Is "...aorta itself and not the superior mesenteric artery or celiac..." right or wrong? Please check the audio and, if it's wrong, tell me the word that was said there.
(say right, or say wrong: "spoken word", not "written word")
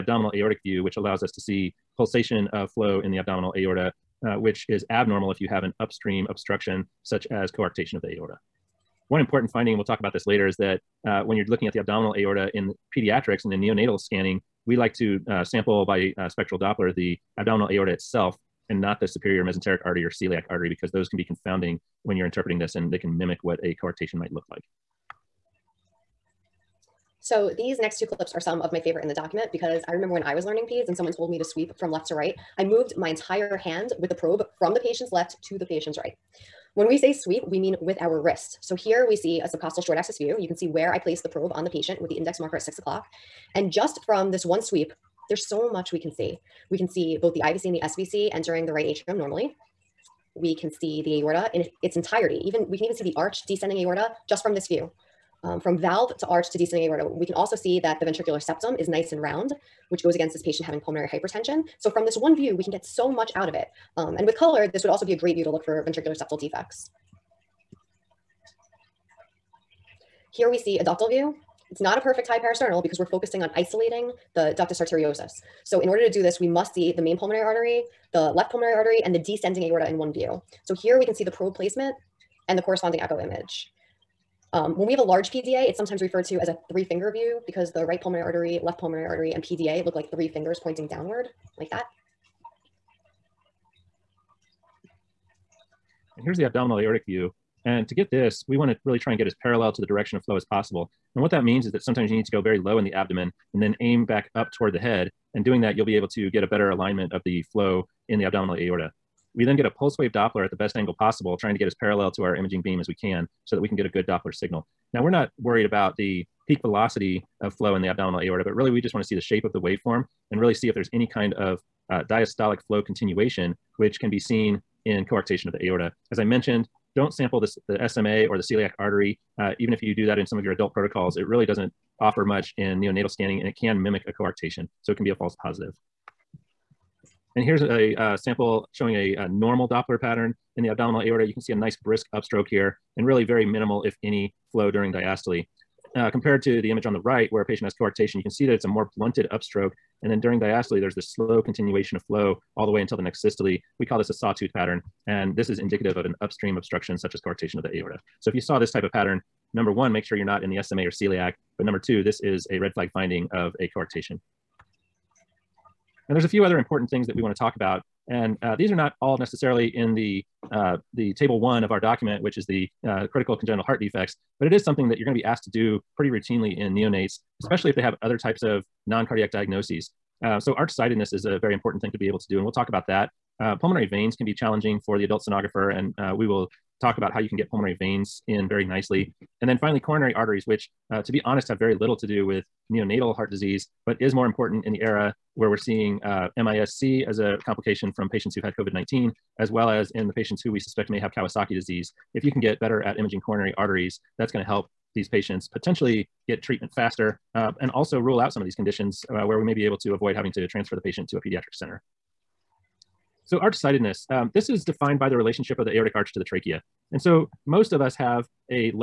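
right.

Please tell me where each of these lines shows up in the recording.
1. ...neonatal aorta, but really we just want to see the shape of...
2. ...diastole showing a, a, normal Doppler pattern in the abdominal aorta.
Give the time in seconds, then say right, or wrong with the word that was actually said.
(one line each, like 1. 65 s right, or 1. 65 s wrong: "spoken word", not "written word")
1. 117 s wrong: "abdominal", not "neonatal"
2. 138 s wrong: "sample", not "diastole".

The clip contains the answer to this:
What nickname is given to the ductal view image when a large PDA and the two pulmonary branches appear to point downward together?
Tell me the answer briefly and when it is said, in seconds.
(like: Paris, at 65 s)
three-finger view, at 86 s.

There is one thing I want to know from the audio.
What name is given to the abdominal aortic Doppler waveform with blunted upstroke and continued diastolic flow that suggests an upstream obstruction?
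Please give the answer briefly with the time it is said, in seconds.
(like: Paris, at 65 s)
sawtooth pattern, at 154 s.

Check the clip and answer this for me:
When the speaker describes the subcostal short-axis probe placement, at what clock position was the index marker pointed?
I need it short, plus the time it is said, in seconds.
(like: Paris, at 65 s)
6 o'clock, at 42 s.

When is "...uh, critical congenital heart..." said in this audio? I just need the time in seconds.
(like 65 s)
172 s.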